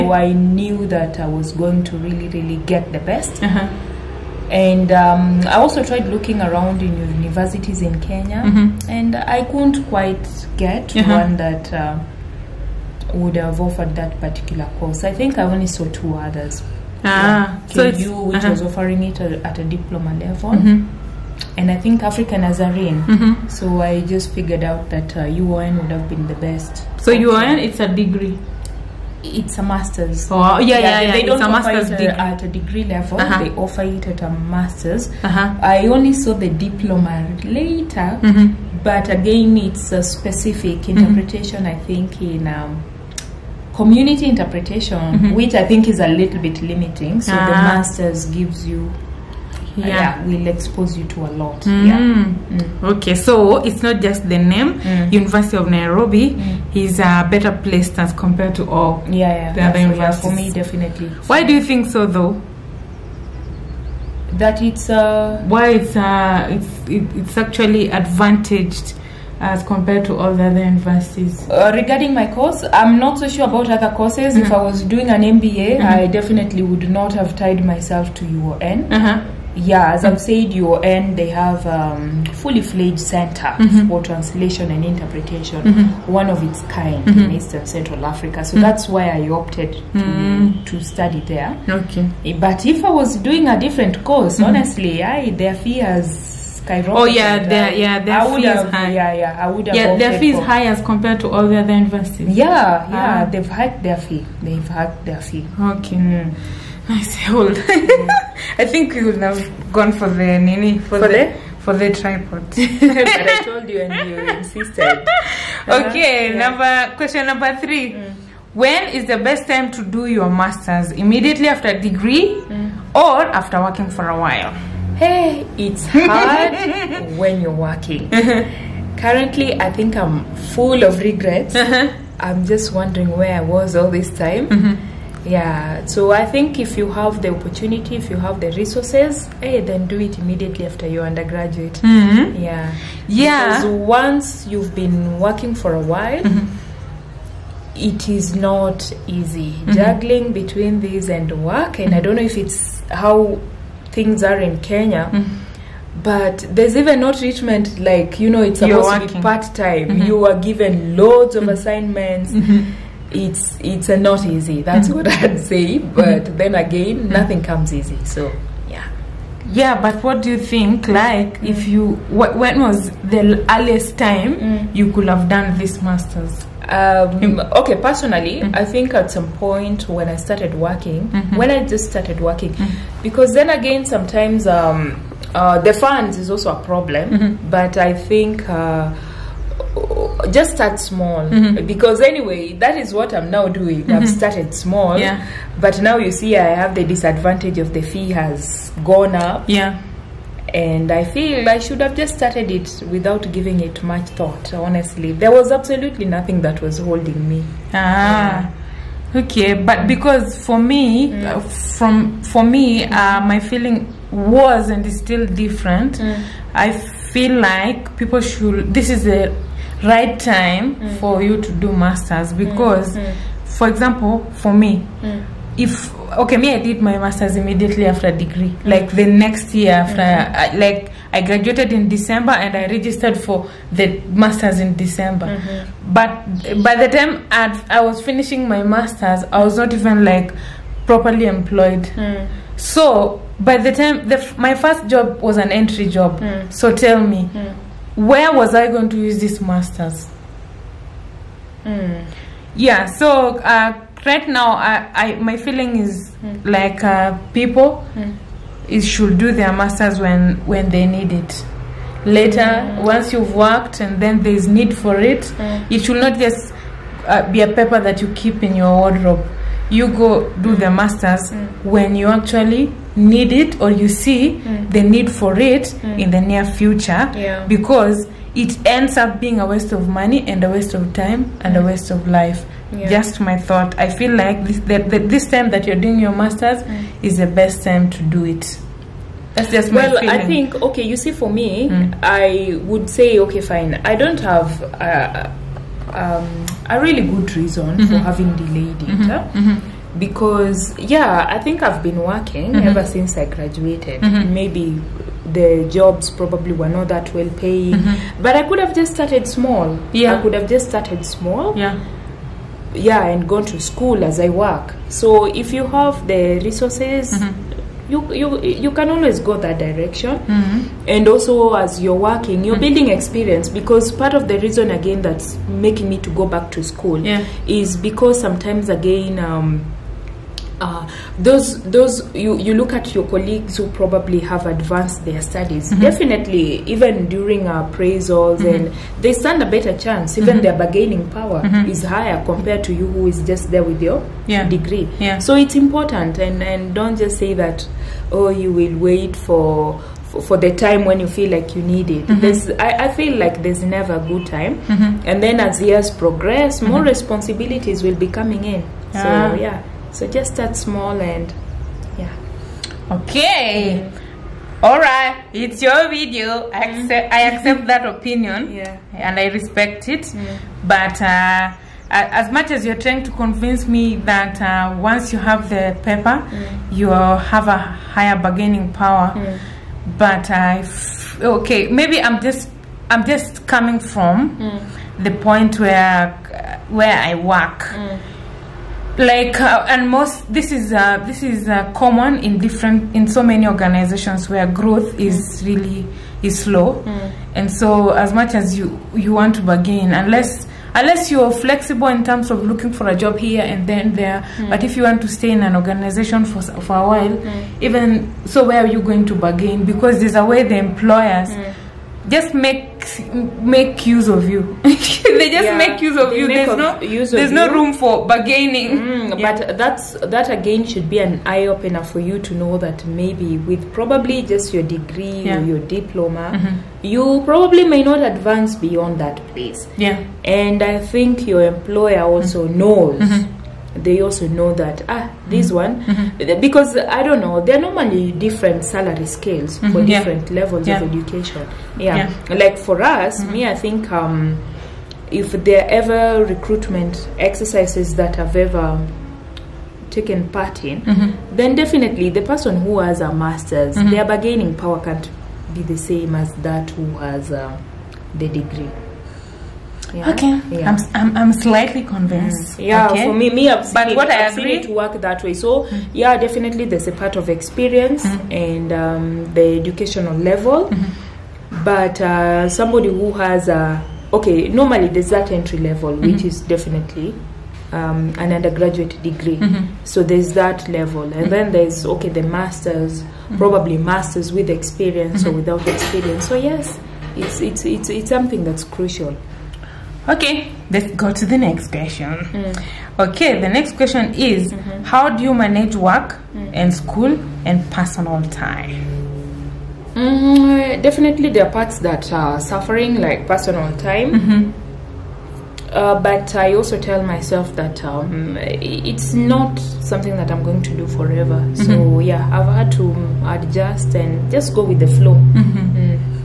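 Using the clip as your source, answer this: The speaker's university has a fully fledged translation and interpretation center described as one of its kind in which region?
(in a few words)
Eastern Central Africa.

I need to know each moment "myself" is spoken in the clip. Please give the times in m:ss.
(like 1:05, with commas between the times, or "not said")
1:17, 8:27.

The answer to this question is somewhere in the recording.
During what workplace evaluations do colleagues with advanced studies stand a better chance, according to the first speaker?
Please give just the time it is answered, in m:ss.
5:37.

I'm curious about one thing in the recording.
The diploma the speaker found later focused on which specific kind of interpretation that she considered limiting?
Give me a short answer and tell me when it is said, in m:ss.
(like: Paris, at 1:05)
Community interpretation, at 0:43.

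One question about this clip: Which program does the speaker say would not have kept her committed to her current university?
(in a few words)
MBA.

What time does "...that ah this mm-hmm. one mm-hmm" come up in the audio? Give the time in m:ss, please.
7:14.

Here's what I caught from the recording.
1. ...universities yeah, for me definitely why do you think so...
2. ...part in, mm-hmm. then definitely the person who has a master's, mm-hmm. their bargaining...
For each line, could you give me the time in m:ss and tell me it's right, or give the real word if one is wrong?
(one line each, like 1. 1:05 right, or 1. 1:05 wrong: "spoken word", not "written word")
1. 0:59 right
2. 7:30 right.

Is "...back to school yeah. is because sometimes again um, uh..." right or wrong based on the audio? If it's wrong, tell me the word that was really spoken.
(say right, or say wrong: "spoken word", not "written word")
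right.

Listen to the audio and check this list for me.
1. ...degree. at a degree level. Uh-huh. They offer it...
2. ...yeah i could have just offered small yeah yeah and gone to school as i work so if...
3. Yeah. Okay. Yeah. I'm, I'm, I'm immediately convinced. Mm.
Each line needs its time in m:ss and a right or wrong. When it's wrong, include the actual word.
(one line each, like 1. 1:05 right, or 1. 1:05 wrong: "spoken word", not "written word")
1. 0:31 right
2. 5:09 wrong: "started", not "offered"
3. 7:39 wrong: "slightly", not "immediately".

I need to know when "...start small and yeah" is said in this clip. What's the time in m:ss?
6:00.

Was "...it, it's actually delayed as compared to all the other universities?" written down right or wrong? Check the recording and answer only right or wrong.
wrong.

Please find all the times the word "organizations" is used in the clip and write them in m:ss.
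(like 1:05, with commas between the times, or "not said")
6:33, 6:45.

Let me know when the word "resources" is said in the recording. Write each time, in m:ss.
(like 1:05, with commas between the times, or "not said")
2:18, 5:16.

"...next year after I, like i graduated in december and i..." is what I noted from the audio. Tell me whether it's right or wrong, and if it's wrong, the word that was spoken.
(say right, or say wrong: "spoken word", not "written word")
right.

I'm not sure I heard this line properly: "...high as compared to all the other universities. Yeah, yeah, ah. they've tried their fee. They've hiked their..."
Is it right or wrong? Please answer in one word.
wrong.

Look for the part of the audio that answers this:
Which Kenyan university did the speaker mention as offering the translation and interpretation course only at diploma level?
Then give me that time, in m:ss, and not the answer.
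0:17.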